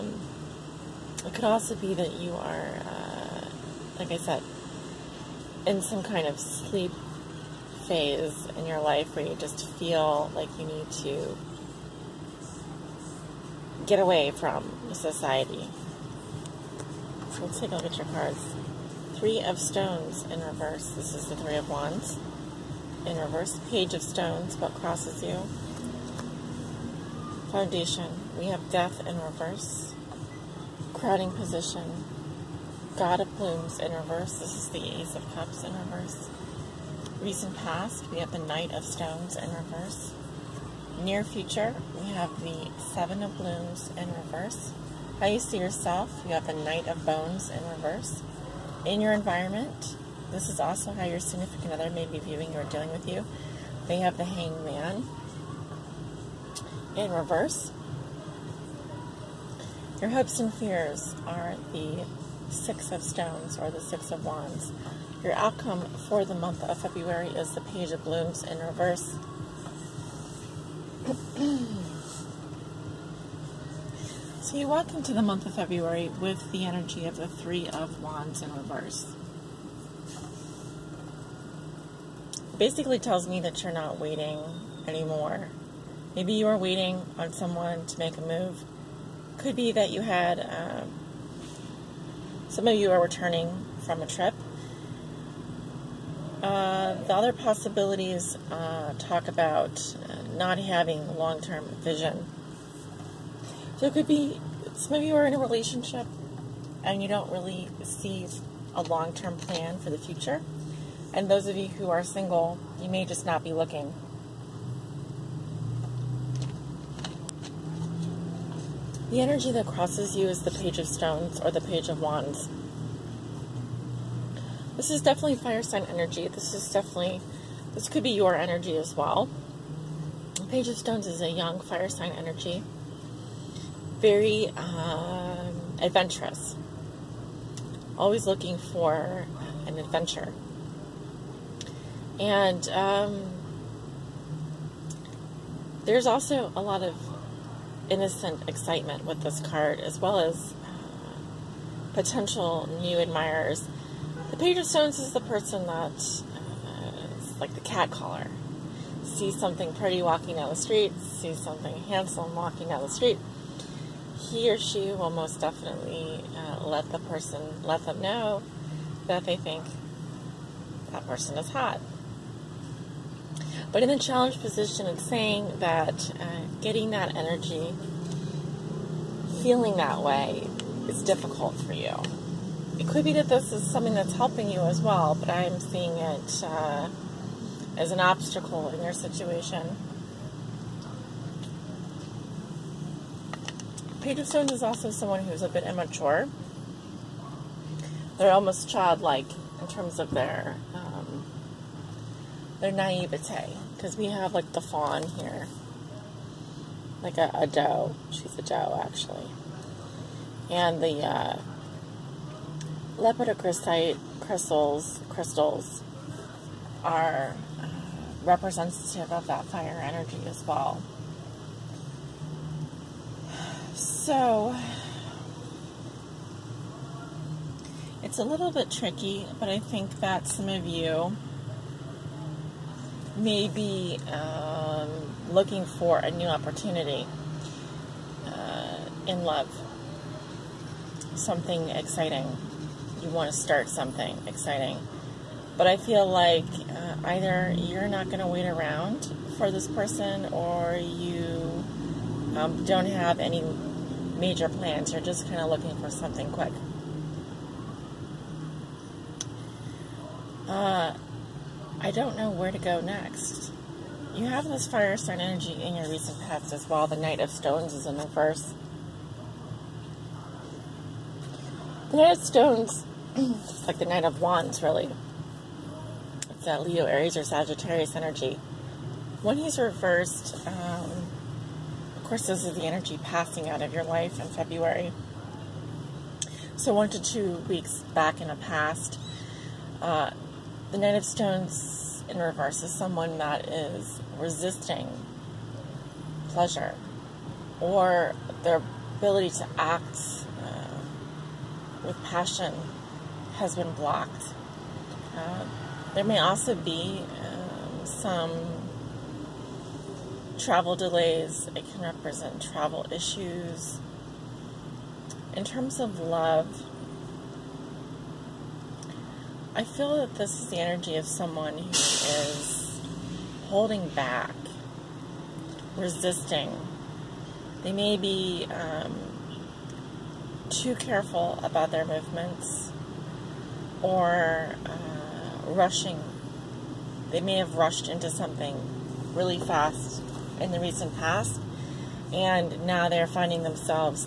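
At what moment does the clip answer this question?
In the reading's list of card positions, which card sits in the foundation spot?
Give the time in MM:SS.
00:28.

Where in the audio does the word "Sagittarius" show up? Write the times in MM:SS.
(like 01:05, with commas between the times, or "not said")
04:37.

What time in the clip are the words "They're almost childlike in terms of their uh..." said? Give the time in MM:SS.
03:18.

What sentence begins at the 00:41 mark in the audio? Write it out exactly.
Near future, we have the Seven of Blooms in reverse.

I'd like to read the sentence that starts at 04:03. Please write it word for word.
You want to start something exciting.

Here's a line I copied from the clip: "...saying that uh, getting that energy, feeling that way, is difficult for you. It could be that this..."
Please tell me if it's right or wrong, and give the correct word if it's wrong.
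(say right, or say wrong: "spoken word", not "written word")
right.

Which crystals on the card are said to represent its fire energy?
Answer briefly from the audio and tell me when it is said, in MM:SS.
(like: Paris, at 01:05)
Lepidocrocite, at 03:32.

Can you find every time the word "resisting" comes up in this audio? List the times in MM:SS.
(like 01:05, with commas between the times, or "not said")
04:54, 05:25.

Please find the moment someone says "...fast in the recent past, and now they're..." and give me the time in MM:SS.
05:39.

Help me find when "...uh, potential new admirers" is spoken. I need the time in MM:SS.
02:30.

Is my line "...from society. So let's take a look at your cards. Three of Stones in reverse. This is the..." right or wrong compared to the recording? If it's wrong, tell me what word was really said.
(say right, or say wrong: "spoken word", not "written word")
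right.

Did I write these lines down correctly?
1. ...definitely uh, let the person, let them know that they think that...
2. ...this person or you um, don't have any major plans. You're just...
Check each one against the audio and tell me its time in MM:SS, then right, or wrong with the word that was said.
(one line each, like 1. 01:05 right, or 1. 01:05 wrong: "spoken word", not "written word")
1. 02:45 right
2. 04:09 right.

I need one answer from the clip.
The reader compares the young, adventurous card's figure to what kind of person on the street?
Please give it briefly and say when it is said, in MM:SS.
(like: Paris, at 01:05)
The cat caller, at 02:37.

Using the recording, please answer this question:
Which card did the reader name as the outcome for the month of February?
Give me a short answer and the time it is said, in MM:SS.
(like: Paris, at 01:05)
Page of Blooms in reverse, at 01:07.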